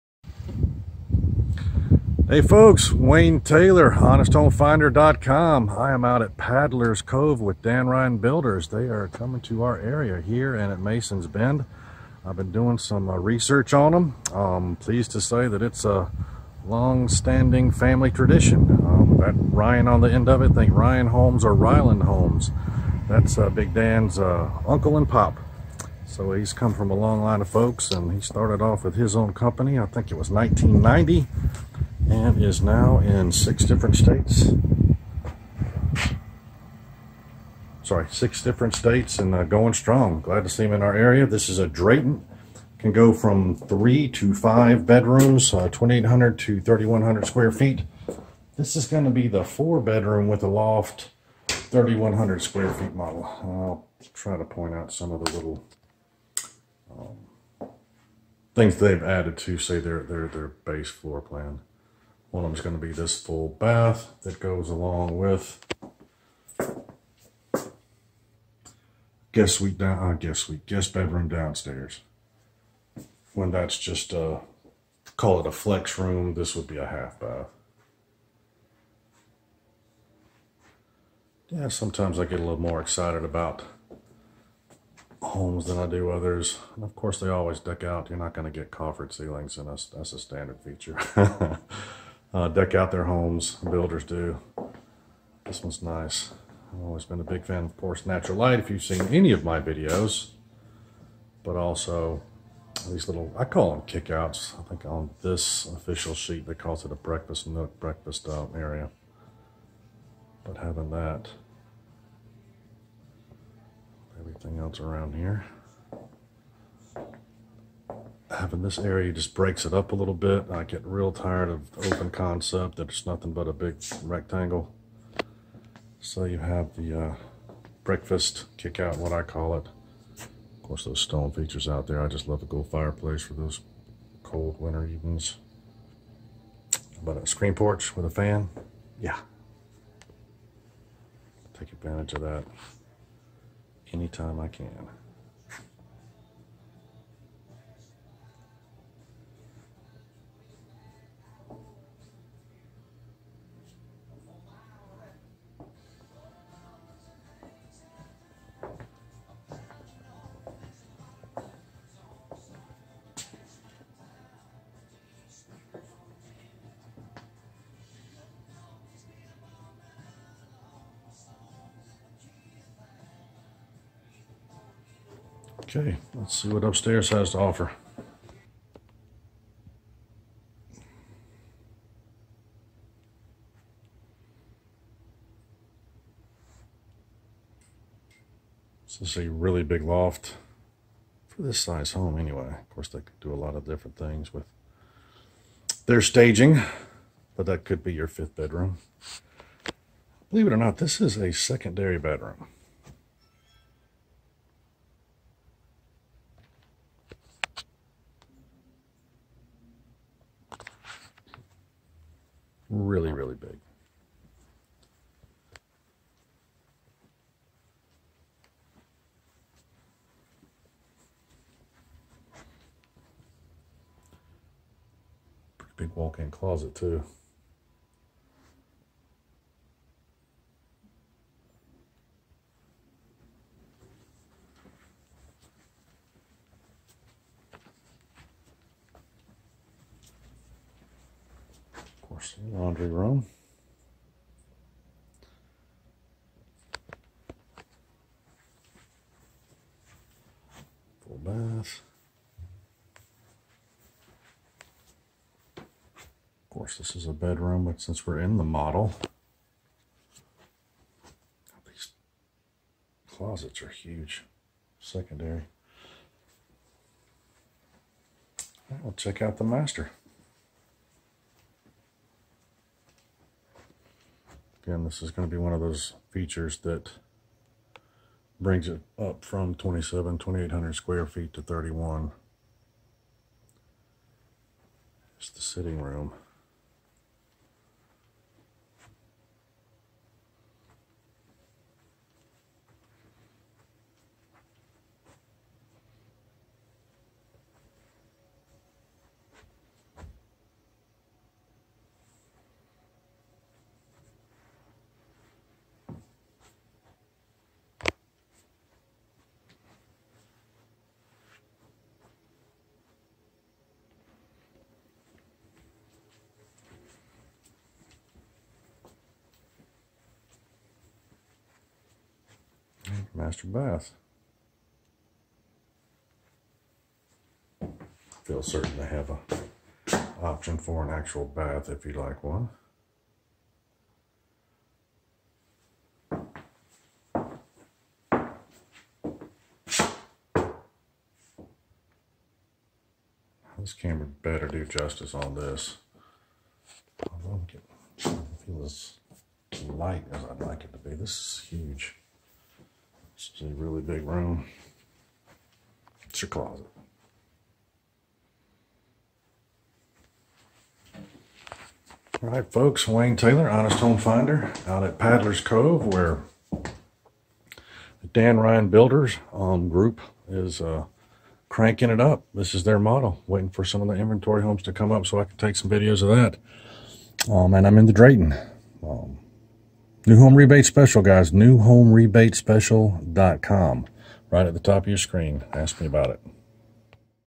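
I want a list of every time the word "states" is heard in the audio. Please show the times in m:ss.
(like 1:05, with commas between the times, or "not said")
0:33, 0:38.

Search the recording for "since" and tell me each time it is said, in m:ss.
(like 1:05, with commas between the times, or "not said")
4:17.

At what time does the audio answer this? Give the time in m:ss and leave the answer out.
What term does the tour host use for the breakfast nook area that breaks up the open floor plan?
1:43.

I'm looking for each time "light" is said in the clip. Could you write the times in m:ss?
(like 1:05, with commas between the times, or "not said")
1:38, 5:49.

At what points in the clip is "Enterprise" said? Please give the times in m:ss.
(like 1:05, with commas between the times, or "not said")
not said.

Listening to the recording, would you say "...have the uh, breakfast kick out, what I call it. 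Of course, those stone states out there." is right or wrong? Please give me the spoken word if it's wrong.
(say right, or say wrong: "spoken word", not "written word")
wrong: "features", not "states".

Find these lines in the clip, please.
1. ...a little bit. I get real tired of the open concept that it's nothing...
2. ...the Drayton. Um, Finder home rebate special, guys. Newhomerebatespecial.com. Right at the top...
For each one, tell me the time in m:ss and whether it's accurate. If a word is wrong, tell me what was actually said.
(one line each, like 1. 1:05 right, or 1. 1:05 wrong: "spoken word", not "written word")
1. 1:59 right
2. 6:17 wrong: "New", not "Finder".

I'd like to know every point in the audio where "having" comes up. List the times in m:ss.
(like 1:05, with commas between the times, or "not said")
1:50, 1:58.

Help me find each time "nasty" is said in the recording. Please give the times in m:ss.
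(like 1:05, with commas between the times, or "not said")
not said.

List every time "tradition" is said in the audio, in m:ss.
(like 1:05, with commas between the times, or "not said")
0:18.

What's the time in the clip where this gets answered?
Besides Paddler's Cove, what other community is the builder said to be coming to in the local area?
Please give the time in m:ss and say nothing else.
0:10.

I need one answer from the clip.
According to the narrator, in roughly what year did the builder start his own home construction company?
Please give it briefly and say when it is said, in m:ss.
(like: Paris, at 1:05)
1990, at 0:30.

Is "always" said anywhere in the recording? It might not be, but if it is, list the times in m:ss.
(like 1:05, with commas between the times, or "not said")
1:27, 1:36.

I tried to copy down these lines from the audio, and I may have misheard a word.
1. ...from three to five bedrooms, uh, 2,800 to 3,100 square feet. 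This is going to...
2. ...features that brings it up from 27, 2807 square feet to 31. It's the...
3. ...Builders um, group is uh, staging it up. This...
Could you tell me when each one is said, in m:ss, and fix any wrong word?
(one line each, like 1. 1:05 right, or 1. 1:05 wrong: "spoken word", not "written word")
1. 0:43 right
2. 4:36 wrong: "2800", not "2807"
3. 6:08 wrong: "cranking", not "staging".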